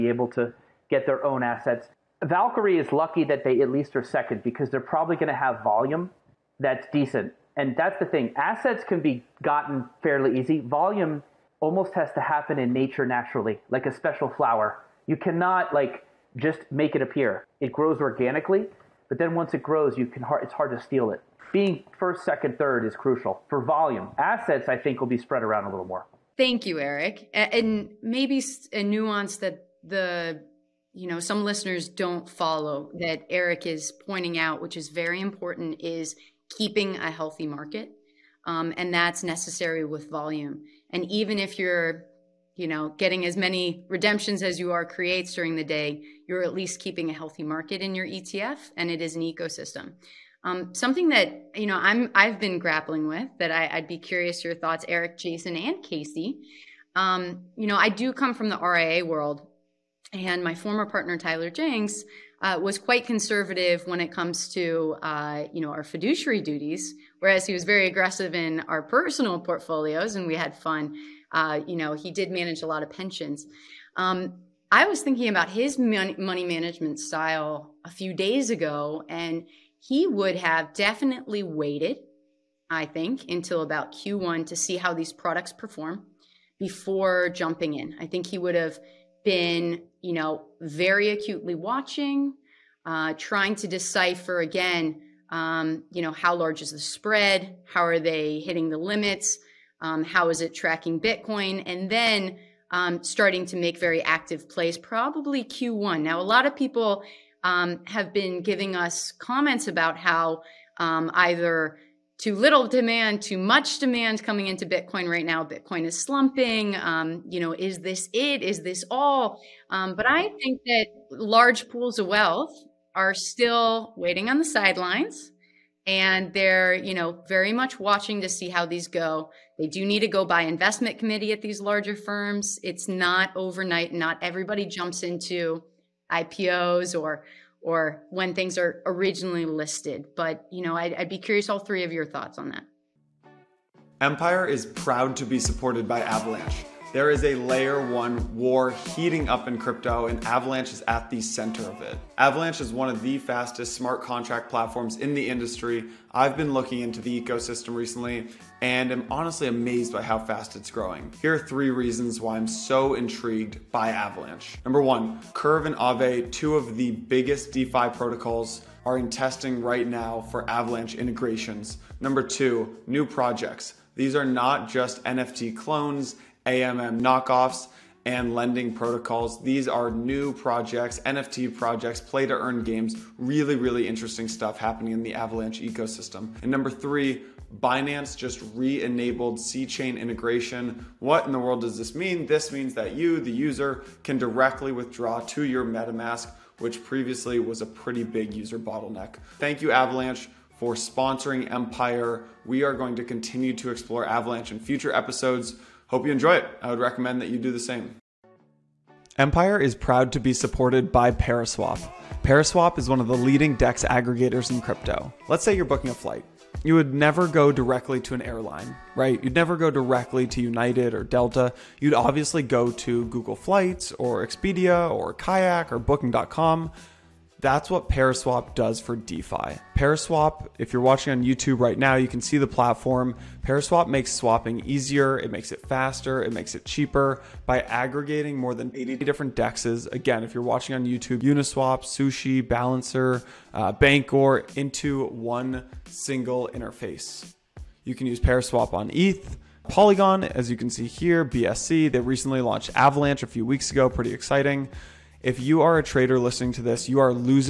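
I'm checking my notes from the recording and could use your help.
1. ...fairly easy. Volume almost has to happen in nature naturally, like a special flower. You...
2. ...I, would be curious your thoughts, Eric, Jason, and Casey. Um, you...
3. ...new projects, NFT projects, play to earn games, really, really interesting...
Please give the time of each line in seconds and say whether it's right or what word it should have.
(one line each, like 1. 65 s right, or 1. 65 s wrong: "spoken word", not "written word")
1. 10 s right
2. 53 s right
3. 179 s right.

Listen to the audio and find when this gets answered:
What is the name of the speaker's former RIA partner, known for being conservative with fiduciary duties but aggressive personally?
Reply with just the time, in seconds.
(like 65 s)
61 s.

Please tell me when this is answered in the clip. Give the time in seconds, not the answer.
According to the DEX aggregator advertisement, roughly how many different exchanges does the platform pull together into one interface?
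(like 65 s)
238 s.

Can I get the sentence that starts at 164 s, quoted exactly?
Number one, Curve and Aave, two of the biggest DeFi protocols, are in testing right now for Avalanche integrations.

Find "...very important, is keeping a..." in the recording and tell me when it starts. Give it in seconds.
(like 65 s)
34 s.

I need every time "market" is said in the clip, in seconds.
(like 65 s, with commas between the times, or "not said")
37 s, 47 s.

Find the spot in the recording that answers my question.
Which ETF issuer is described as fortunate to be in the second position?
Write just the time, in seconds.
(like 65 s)
2 s.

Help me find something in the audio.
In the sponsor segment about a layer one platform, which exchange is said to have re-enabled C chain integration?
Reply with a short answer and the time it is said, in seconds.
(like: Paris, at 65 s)
Binance, at 187 s.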